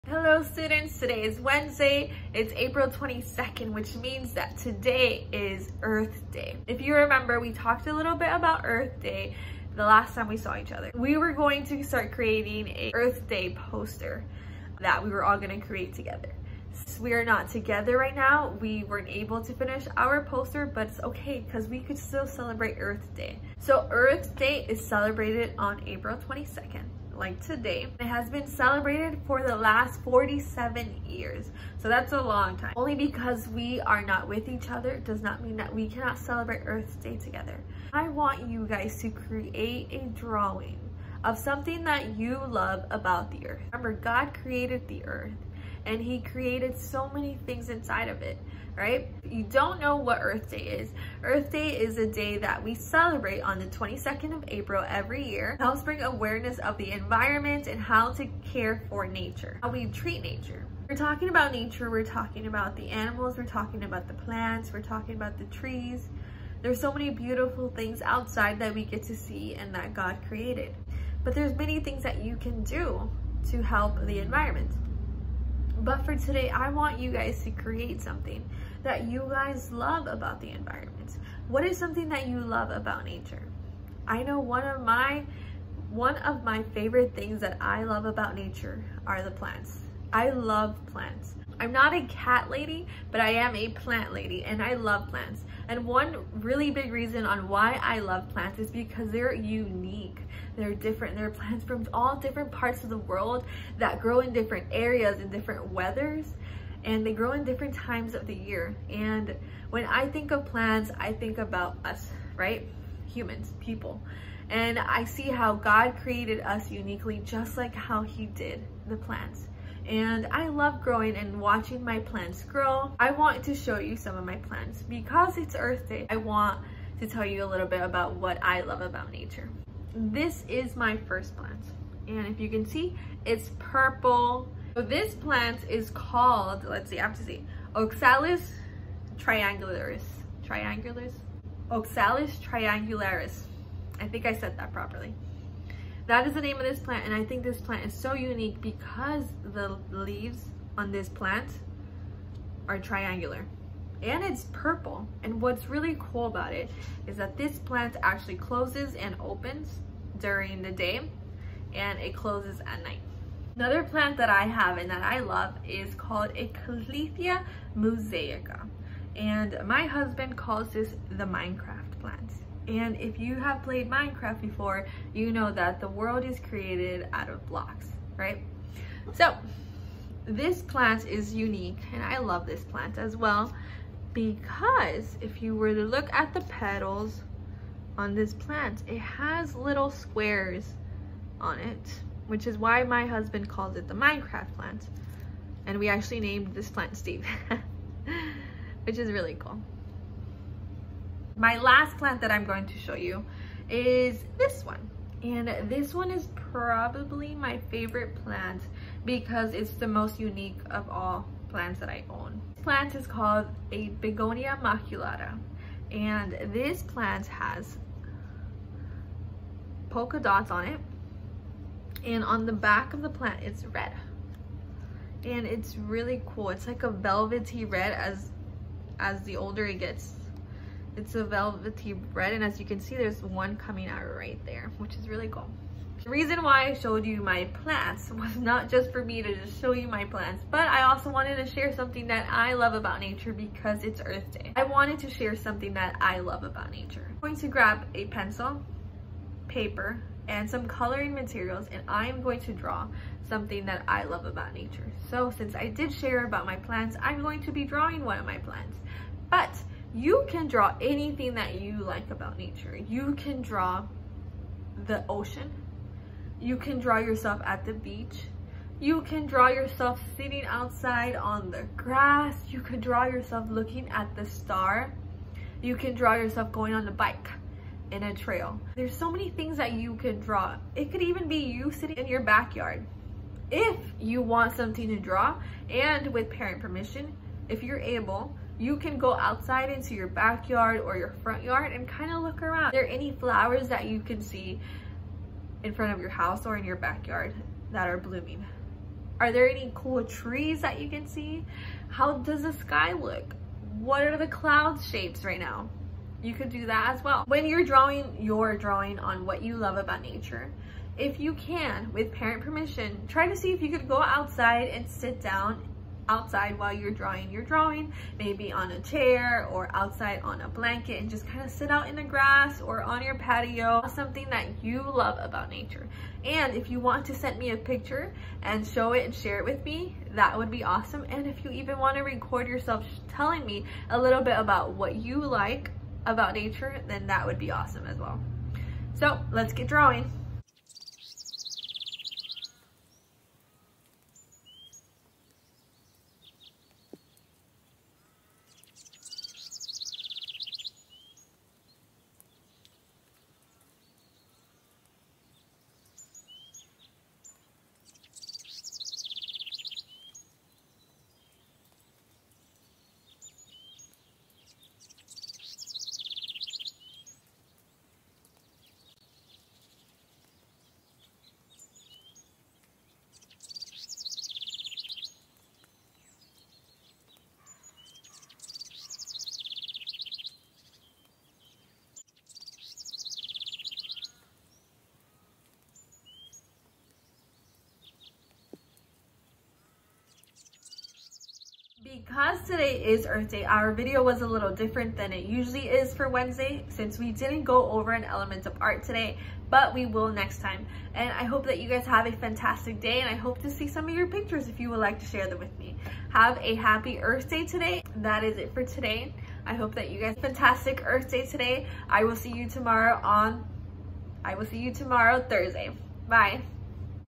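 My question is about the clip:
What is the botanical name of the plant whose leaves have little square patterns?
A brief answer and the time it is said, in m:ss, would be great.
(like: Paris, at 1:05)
Calathea mosaica, at 2:46.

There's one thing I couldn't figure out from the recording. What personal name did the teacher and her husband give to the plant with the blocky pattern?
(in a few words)
Steve.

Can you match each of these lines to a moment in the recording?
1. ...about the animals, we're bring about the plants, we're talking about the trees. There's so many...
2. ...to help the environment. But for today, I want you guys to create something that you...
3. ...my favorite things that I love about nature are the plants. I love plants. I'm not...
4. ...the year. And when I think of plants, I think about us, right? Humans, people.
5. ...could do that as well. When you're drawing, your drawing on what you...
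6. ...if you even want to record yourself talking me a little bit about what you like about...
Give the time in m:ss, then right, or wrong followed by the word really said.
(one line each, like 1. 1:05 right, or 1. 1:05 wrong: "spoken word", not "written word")
1. 1:02 wrong: "talking", not "bring"
2. 1:13 right
3. 1:26 right
4. 1:48 right
5. 5:06 right
6. 5:31 wrong: "telling", not "talking".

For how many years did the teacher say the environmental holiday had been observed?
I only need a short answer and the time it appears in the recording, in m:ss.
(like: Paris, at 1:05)
47, at 0:30.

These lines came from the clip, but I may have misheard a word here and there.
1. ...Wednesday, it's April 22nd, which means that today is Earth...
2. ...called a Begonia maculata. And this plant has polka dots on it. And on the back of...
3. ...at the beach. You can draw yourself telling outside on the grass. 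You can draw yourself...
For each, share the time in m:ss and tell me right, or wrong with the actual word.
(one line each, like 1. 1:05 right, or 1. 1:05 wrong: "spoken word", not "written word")
1. 0:01 right
2. 3:33 right
3. 4:27 wrong: "sitting", not "telling".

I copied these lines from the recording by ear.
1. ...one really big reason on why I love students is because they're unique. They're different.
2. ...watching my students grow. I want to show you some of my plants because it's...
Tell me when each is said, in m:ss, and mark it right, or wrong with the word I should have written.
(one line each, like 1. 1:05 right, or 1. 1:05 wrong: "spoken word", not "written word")
1. 1:35 wrong: "plants", not "students"
2. 2:01 wrong: "plants", not "students".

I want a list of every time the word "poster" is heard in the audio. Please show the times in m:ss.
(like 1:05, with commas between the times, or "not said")
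0:13, 0:20.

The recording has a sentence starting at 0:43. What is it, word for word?
Remember, God created the earth and he created so many things inside of it right?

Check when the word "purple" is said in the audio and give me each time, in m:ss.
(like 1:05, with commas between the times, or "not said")
2:13, 2:34.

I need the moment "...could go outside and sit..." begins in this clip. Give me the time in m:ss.
5:13.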